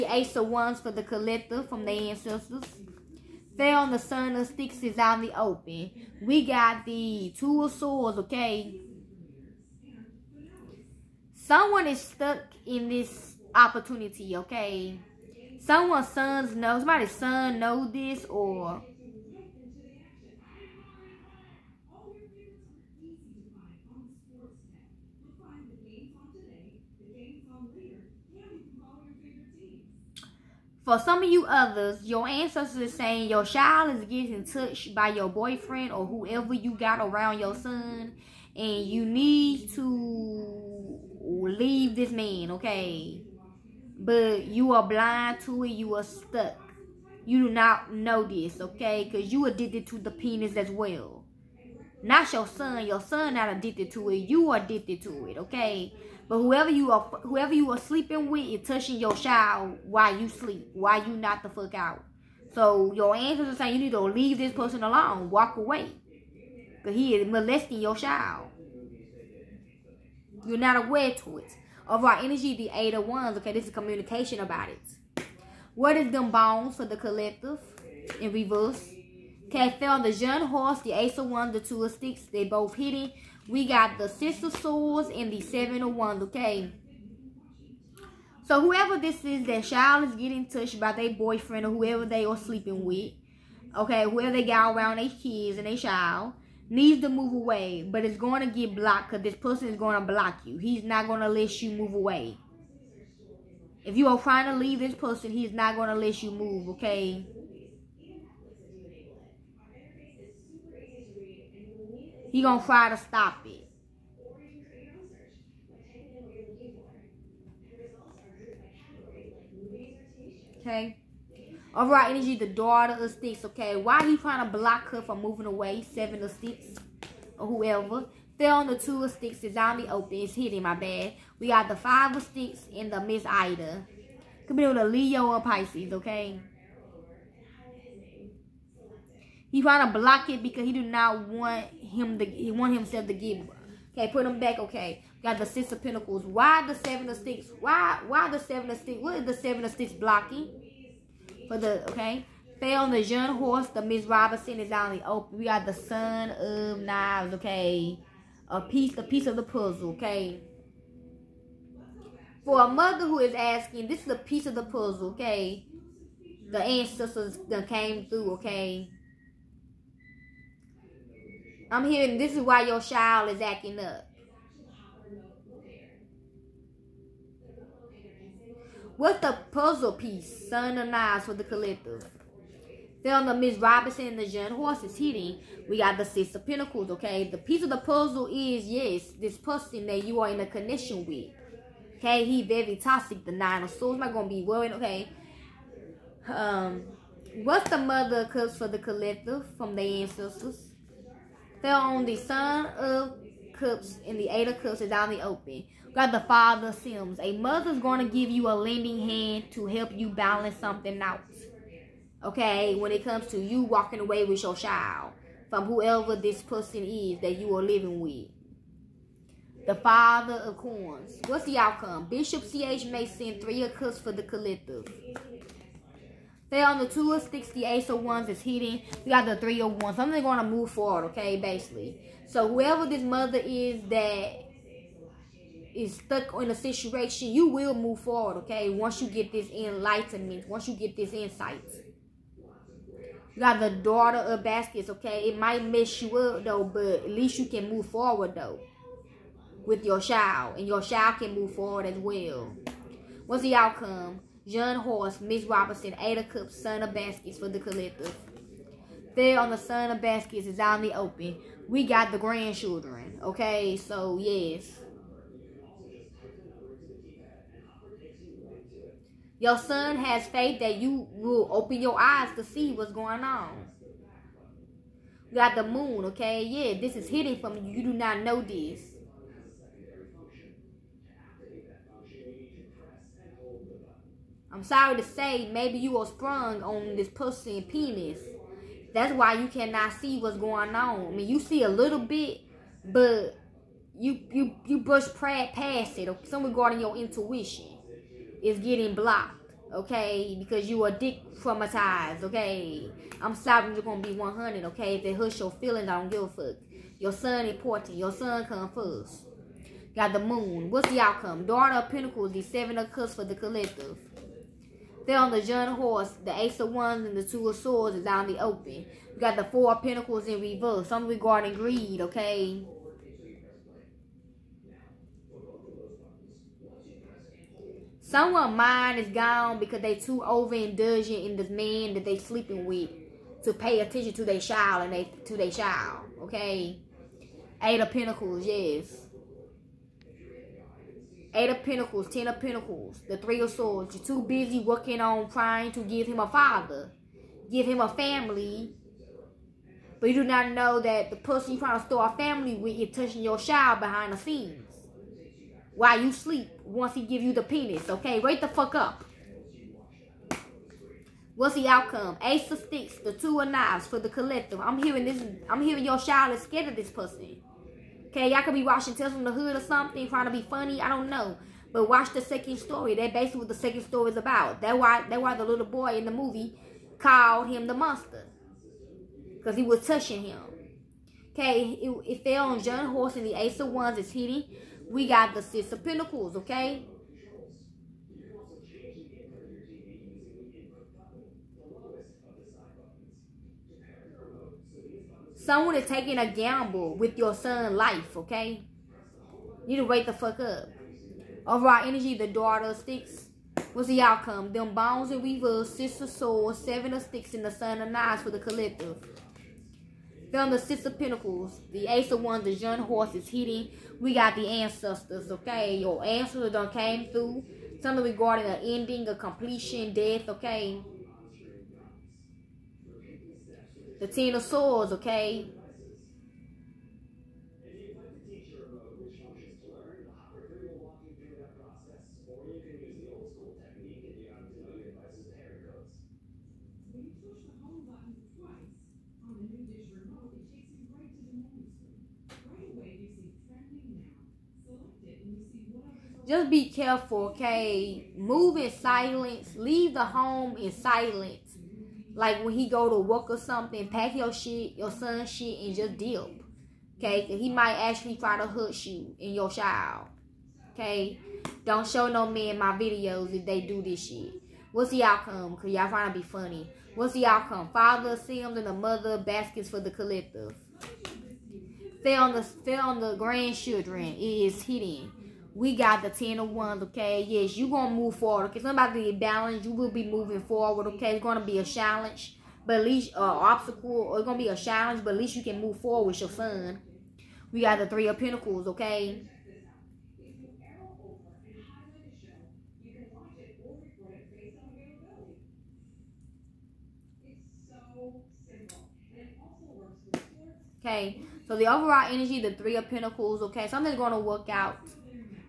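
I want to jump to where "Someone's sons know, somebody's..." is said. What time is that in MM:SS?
00:15.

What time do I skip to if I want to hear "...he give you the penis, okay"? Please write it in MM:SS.
05:56.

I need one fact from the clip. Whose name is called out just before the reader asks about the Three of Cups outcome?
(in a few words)
Bishop C.H. Mason.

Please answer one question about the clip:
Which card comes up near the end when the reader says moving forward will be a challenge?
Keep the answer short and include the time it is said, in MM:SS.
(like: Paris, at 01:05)
Ten of Wands, at 07:56.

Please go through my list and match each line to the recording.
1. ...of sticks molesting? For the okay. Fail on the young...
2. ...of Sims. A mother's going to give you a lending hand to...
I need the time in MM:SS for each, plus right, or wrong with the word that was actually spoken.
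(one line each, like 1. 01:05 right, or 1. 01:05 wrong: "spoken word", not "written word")
1. 02:29 wrong: "blocking", not "molesting"
2. 03:26 right.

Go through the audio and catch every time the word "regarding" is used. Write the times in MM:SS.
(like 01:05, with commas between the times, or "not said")
04:56, 05:21, 06:58.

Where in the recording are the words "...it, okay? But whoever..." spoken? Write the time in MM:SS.
00:55.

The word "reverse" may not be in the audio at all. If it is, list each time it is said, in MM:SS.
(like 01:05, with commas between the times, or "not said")
01:18, 05:20.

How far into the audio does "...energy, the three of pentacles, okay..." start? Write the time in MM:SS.
08:22.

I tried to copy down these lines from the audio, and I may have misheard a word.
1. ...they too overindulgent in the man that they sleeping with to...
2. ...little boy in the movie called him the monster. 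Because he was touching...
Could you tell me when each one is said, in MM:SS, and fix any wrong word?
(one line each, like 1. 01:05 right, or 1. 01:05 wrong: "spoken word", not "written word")
1. 05:29 right
2. 06:15 right.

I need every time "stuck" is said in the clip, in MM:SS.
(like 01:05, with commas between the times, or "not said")
00:12, 00:46, 03:55.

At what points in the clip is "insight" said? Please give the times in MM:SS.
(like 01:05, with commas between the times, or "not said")
04:01.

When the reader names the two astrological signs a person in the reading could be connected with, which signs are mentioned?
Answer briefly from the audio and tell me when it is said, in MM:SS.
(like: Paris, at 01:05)
Leo or Pisces, at 02:14.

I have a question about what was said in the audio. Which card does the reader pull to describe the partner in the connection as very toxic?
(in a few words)
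Nine of Swords.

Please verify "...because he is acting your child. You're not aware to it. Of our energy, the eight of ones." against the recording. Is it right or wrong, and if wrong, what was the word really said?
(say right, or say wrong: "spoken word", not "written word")
wrong: "molesting", not "acting".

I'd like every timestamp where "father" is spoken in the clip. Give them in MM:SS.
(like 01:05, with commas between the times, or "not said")
03:26, 03:39, 05:46, 07:47.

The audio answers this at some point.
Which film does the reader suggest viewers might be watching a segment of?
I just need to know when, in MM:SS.
06:08.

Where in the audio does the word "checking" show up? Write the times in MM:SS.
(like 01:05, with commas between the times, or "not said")
not said.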